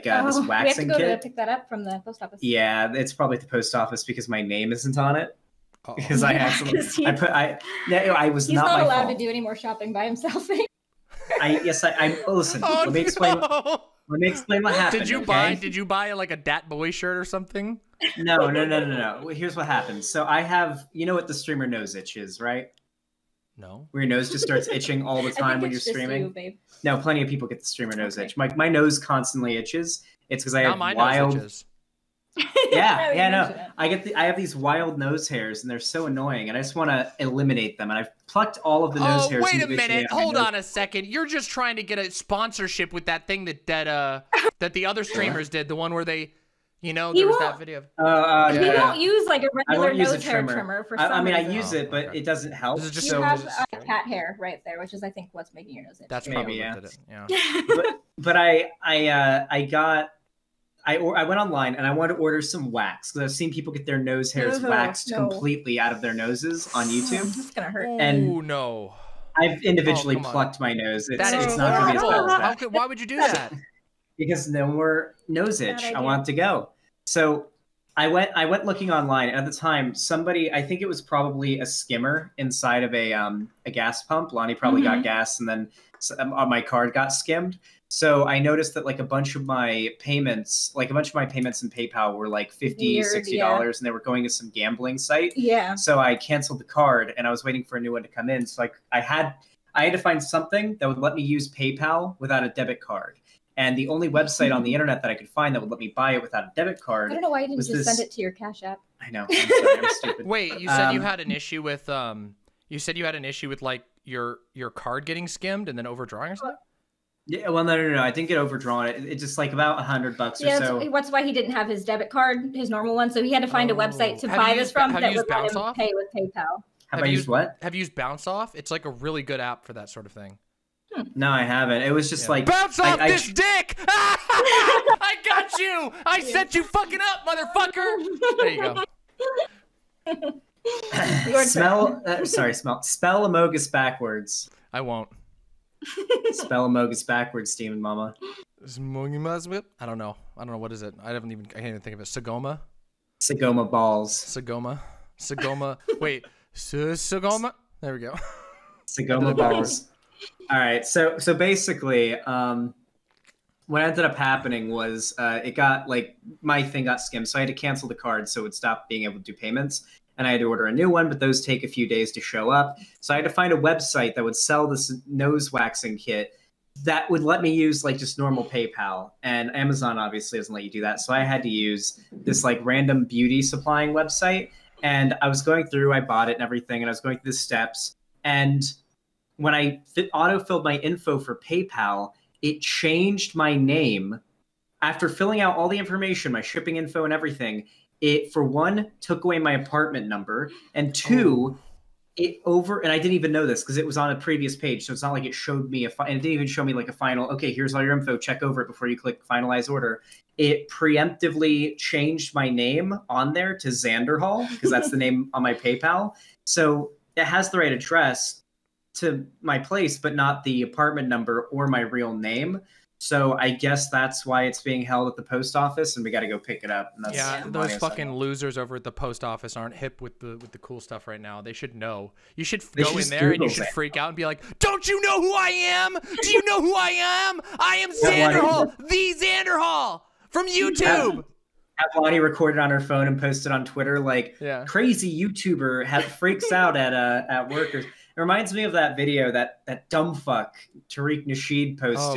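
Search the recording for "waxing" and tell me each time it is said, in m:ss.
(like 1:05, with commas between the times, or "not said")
0:00, 2:55.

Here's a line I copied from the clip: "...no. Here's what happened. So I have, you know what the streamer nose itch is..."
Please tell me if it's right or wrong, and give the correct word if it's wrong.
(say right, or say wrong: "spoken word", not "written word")
right.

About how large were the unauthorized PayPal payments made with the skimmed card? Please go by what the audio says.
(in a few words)
50 to 60 dollars.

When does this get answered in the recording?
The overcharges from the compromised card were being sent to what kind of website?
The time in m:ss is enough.
1:34.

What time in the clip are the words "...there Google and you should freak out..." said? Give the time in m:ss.
3:53.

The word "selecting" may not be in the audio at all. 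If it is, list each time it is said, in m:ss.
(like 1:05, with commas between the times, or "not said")
not said.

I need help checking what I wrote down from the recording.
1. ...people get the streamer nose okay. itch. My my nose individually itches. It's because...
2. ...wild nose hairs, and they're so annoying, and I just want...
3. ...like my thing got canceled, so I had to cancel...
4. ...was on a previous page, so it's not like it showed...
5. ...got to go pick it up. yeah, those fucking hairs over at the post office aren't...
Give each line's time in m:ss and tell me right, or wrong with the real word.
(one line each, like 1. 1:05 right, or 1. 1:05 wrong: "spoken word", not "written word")
1. 0:27 wrong: "constantly", not "individually"
2. 0:34 right
3. 2:45 wrong: "skimmed", not "canceled"
4. 3:23 right
5. 3:46 wrong: "losers", not "hairs".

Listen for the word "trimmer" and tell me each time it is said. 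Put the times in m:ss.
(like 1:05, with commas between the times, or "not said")
0:50.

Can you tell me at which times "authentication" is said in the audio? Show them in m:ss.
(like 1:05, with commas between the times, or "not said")
not said.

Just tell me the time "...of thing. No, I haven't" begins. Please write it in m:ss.
2:10.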